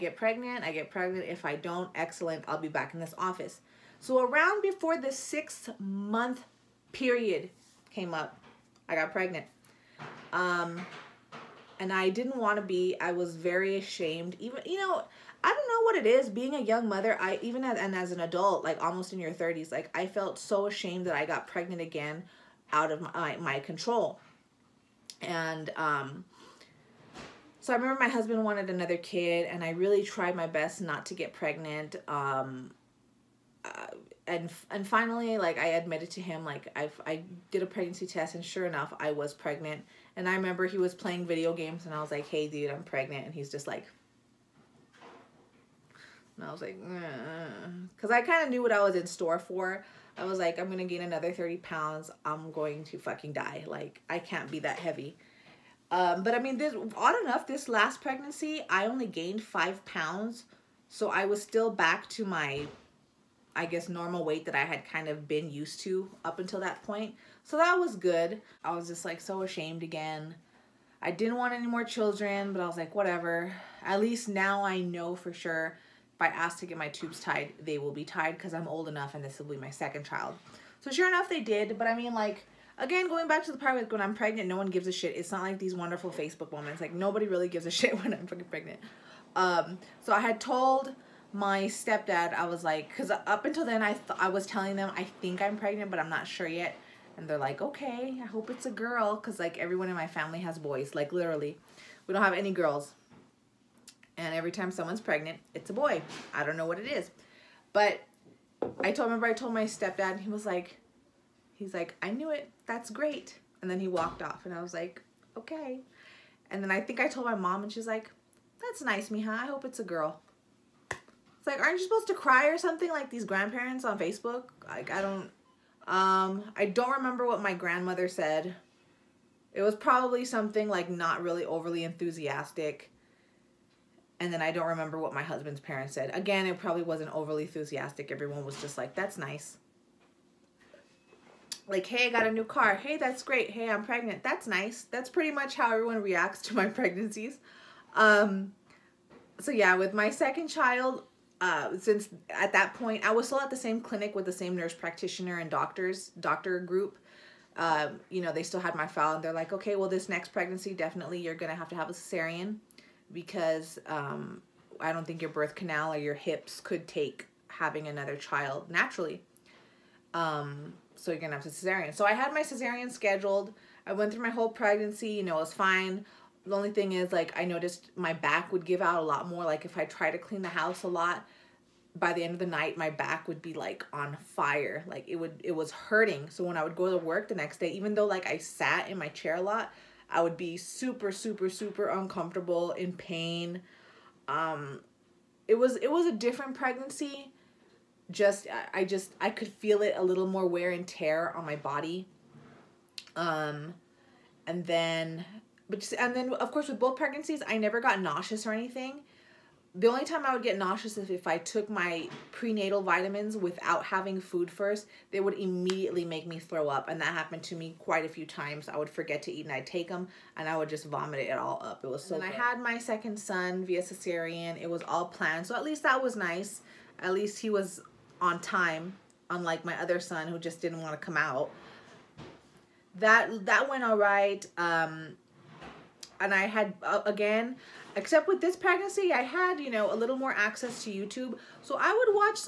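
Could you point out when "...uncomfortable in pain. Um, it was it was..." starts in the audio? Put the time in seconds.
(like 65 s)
191 s.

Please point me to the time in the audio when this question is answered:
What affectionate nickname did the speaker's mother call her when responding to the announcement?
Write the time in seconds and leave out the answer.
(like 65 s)
119 s.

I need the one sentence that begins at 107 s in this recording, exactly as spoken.
But I told remember I told my stepdad and he was like he's like, I knew it, that's great.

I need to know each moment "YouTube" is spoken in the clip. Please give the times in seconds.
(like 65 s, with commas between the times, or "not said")
240 s.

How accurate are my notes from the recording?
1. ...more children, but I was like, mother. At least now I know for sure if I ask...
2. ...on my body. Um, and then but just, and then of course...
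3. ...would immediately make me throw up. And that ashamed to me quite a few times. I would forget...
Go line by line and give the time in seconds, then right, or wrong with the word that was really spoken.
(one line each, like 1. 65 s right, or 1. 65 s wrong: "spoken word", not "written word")
1. 71 s wrong: "whatever", not "mother"
2. 201 s right
3. 215 s wrong: "happened", not "ashamed".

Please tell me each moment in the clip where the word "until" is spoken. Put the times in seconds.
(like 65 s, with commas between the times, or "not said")
66 s, 93 s.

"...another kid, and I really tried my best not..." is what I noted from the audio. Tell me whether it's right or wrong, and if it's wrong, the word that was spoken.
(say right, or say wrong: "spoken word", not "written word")
right.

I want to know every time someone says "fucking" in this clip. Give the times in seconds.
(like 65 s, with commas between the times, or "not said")
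52 s, 88 s.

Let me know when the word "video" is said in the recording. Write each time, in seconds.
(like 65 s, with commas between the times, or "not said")
41 s.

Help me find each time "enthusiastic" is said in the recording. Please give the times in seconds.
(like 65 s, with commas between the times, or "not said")
131 s, 137 s.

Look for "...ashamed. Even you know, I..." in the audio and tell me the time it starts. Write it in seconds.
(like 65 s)
13 s.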